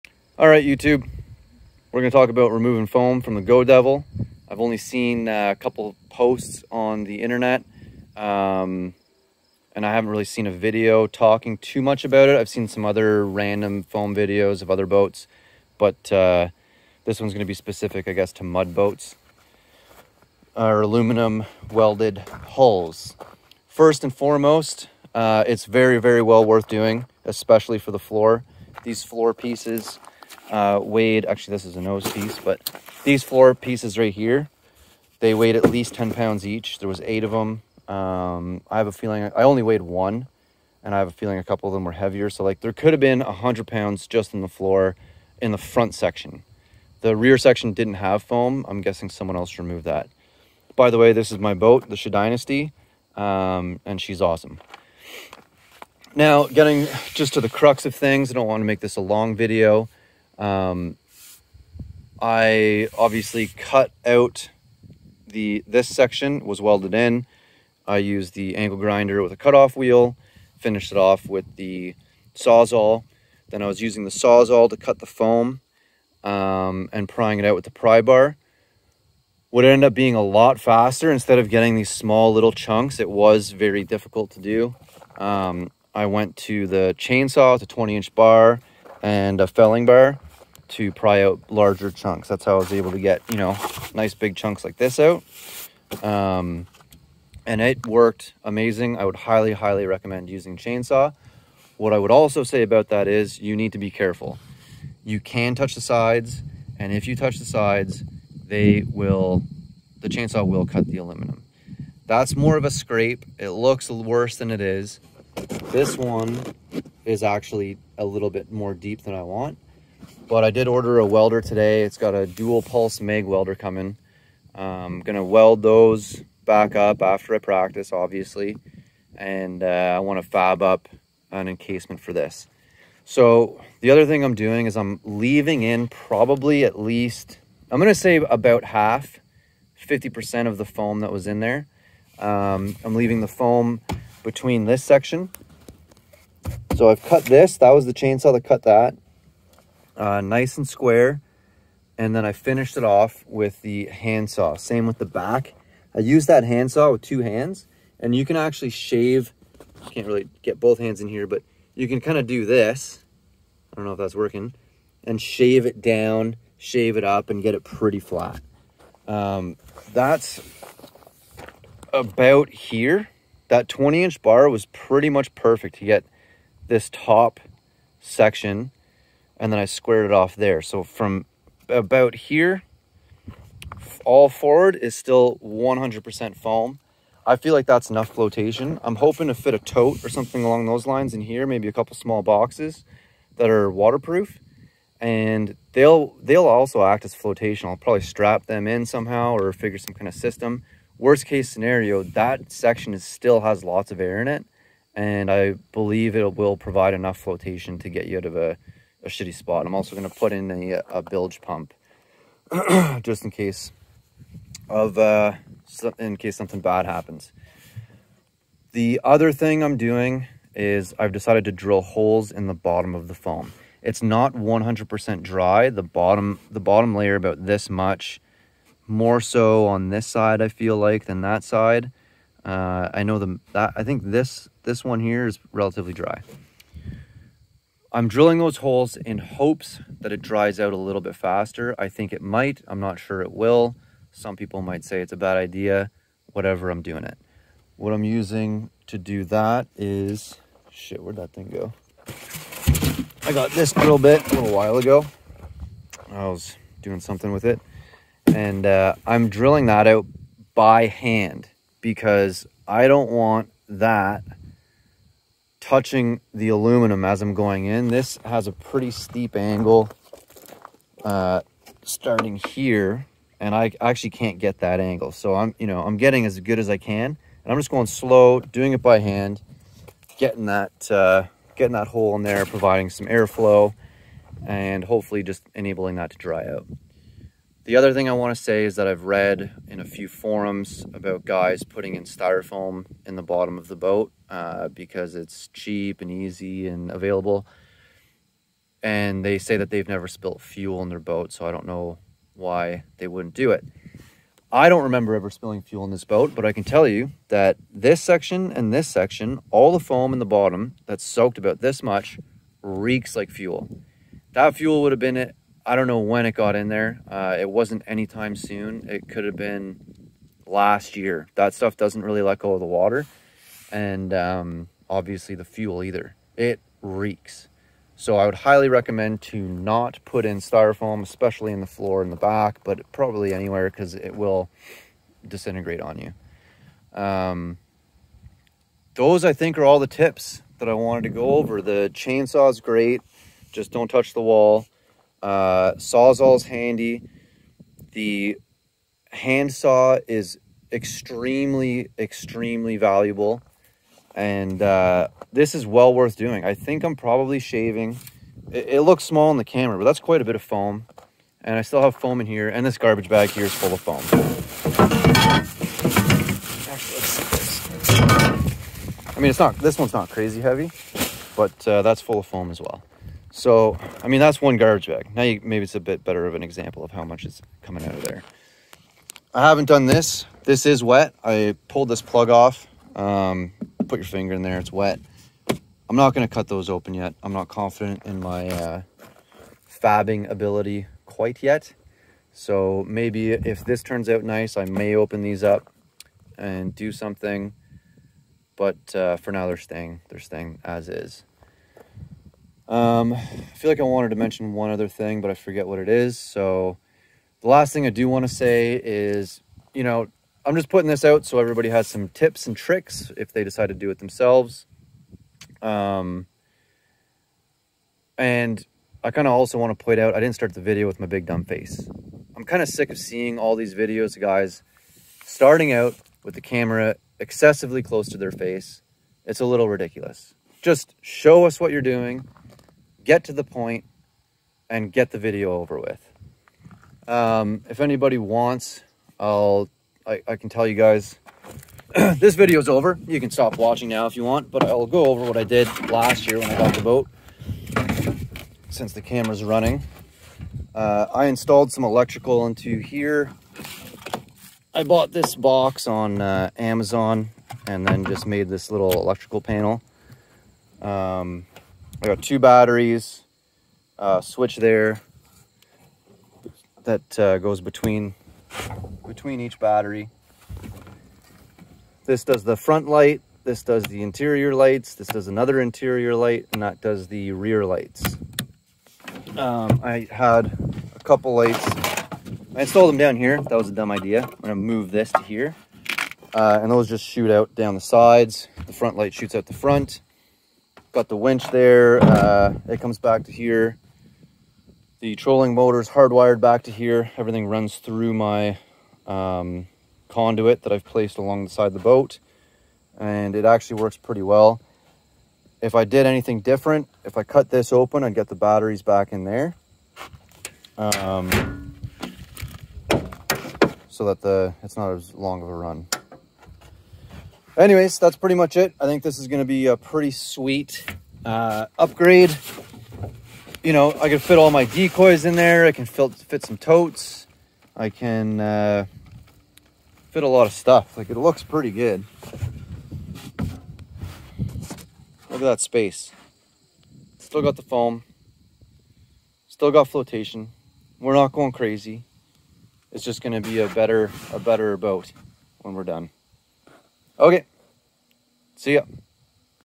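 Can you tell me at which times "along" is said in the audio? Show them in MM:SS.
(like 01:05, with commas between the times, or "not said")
03:10, 08:21.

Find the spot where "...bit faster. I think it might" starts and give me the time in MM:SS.
04:01.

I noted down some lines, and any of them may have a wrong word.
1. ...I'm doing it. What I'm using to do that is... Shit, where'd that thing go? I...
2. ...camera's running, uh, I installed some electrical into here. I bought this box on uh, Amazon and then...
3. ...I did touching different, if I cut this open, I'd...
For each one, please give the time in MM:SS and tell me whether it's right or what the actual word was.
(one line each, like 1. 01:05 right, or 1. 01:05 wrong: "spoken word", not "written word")
1. 04:06 right
2. 07:29 right
3. 08:25 wrong: "anything", not "touching".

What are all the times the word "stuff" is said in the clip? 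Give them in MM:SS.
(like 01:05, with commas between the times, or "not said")
05:21, 08:50.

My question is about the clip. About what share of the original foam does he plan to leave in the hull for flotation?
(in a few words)
50%.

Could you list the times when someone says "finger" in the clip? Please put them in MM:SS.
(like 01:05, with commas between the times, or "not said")
06:24.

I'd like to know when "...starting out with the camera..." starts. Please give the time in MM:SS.
07:05.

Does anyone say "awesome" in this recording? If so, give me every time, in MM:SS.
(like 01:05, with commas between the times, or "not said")
00:54.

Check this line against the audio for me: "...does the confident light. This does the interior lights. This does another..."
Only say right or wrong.
wrong.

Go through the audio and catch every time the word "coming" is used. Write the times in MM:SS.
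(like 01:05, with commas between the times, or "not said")
02:03, 06:17.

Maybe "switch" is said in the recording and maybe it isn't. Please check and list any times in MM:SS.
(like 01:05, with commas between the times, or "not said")
07:44.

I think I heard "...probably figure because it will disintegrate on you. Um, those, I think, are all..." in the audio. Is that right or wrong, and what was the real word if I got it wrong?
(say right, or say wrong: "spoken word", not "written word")
wrong: "anywhere", not "figure".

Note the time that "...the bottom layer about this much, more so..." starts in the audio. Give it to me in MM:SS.
03:46.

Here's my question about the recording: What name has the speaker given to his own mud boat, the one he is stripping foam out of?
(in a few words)
Shea Dynasty.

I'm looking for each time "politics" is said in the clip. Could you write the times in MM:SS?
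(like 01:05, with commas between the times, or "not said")
not said.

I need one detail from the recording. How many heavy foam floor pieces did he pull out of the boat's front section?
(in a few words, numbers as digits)
8.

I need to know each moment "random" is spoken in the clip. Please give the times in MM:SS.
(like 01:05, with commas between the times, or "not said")
00:13.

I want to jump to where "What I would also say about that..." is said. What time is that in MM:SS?
01:41.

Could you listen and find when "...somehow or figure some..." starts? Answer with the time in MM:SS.
03:18.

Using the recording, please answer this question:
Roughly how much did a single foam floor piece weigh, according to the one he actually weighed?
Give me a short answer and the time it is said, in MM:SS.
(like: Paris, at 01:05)
10 pounds, at 00:35.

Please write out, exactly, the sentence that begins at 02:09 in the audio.
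And uh, I wanna fab up an encasement for this.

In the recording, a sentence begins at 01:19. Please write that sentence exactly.
Would end up being a lot faster instead of getting these small little chunks.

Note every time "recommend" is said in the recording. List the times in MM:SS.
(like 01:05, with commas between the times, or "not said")
01:39, 05:28.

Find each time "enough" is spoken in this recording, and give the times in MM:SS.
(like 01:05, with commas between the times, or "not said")
03:07, 03:26.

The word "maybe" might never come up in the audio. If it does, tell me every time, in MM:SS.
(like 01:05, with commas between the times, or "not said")
03:11, 06:15, 06:32.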